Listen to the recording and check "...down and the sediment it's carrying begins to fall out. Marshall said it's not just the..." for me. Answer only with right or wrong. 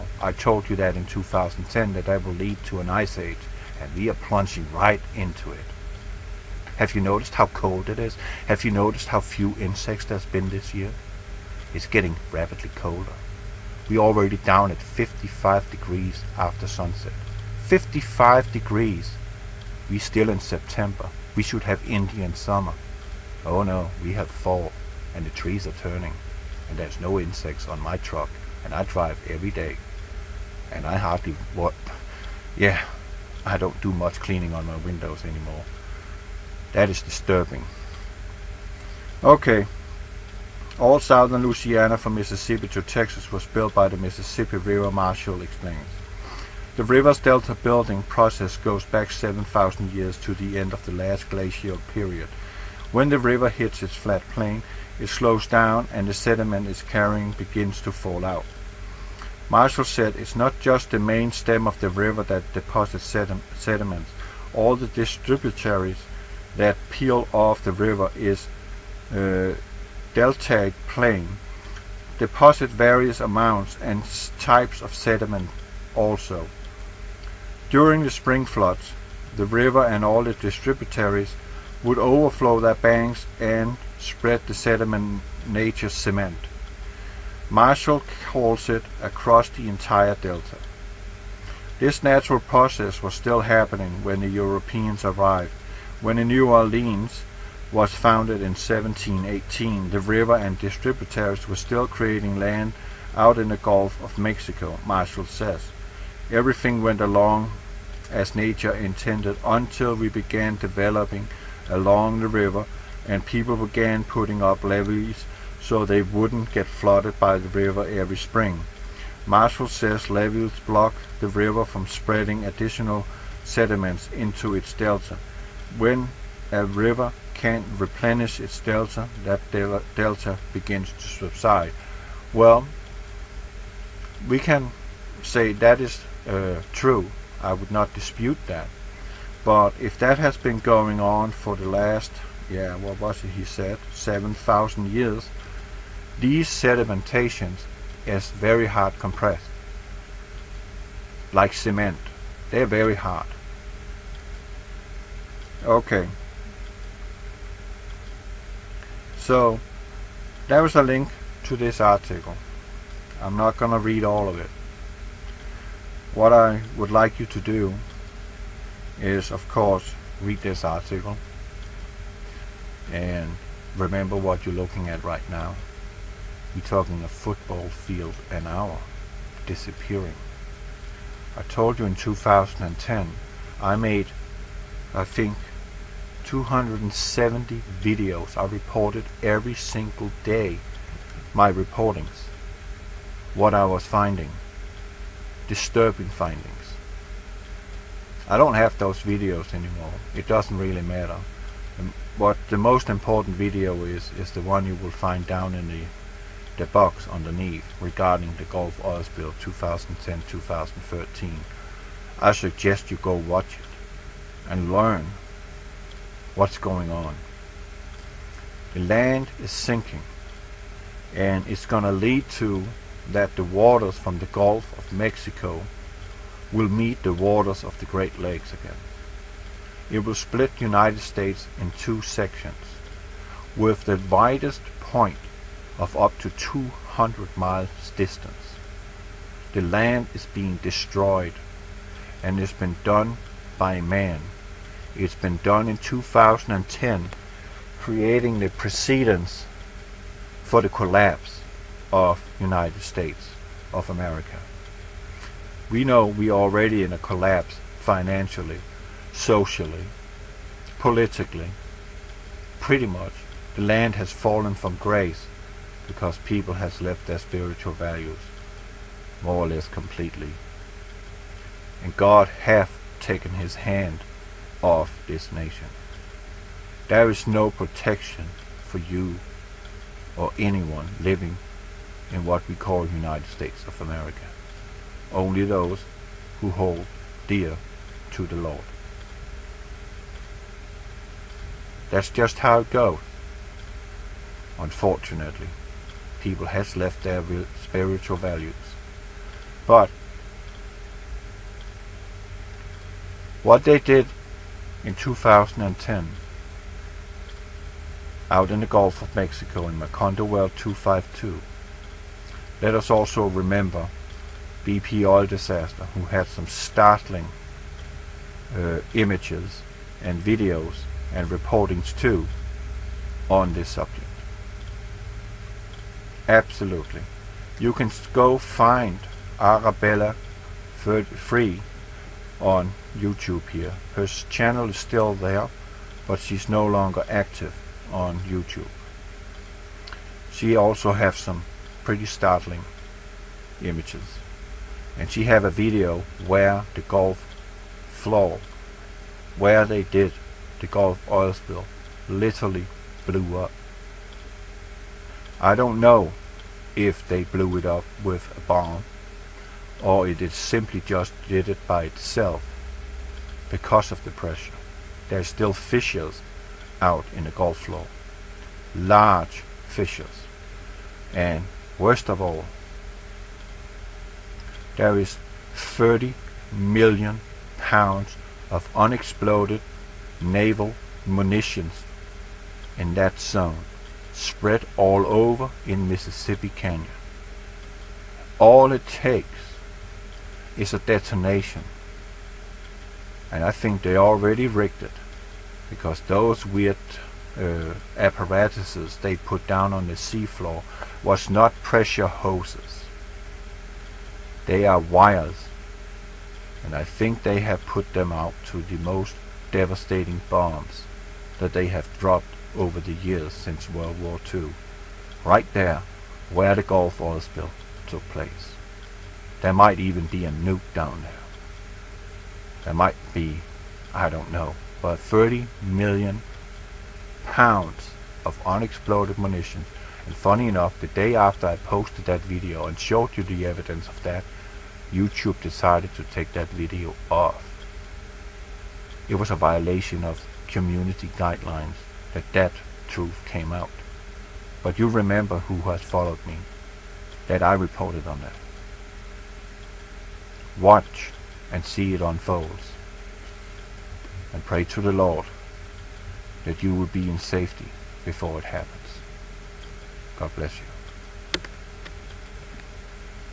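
right.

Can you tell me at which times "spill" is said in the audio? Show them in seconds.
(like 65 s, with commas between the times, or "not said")
209 s, 351 s, 417 s.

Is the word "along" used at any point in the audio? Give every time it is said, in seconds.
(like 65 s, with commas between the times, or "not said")
107 s, 111 s.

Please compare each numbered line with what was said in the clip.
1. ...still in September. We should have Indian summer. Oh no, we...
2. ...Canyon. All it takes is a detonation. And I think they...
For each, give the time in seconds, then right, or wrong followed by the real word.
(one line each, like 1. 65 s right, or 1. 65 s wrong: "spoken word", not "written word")
1. 19 s right
2. 386 s right.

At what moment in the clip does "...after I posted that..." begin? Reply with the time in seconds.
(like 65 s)
431 s.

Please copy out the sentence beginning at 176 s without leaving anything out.
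We're talking a football field an hour disappearing.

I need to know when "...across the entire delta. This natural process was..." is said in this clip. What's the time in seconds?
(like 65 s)
89 s.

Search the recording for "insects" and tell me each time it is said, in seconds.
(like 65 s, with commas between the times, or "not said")
9 s, 27 s.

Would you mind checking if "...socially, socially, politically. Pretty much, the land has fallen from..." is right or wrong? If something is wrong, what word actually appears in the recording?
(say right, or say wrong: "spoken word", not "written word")
wrong: "financially", not "socially".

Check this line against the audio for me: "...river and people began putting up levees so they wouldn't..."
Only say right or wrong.
right.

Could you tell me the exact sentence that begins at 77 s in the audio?
During the spring floods, the river and all the distributaries would overflow their banks and spread the sediment nature's cement.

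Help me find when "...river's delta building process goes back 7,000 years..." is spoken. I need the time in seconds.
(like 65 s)
46 s.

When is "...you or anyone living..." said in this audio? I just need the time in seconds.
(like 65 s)
278 s.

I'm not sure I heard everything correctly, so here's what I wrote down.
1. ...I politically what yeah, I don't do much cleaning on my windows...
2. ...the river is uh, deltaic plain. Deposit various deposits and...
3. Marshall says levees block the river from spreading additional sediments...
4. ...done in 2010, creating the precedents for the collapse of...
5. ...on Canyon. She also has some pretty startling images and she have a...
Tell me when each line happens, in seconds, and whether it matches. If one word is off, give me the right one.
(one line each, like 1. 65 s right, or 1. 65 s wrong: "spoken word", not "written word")
1. 30 s wrong: "hardly", not "politically"
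2. 67 s wrong: "amounts", not "deposits"
3. 119 s right
4. 245 s right
5. 337 s wrong: "YouTube", not "Canyon".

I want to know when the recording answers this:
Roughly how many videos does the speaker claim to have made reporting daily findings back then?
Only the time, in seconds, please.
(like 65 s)
186 s.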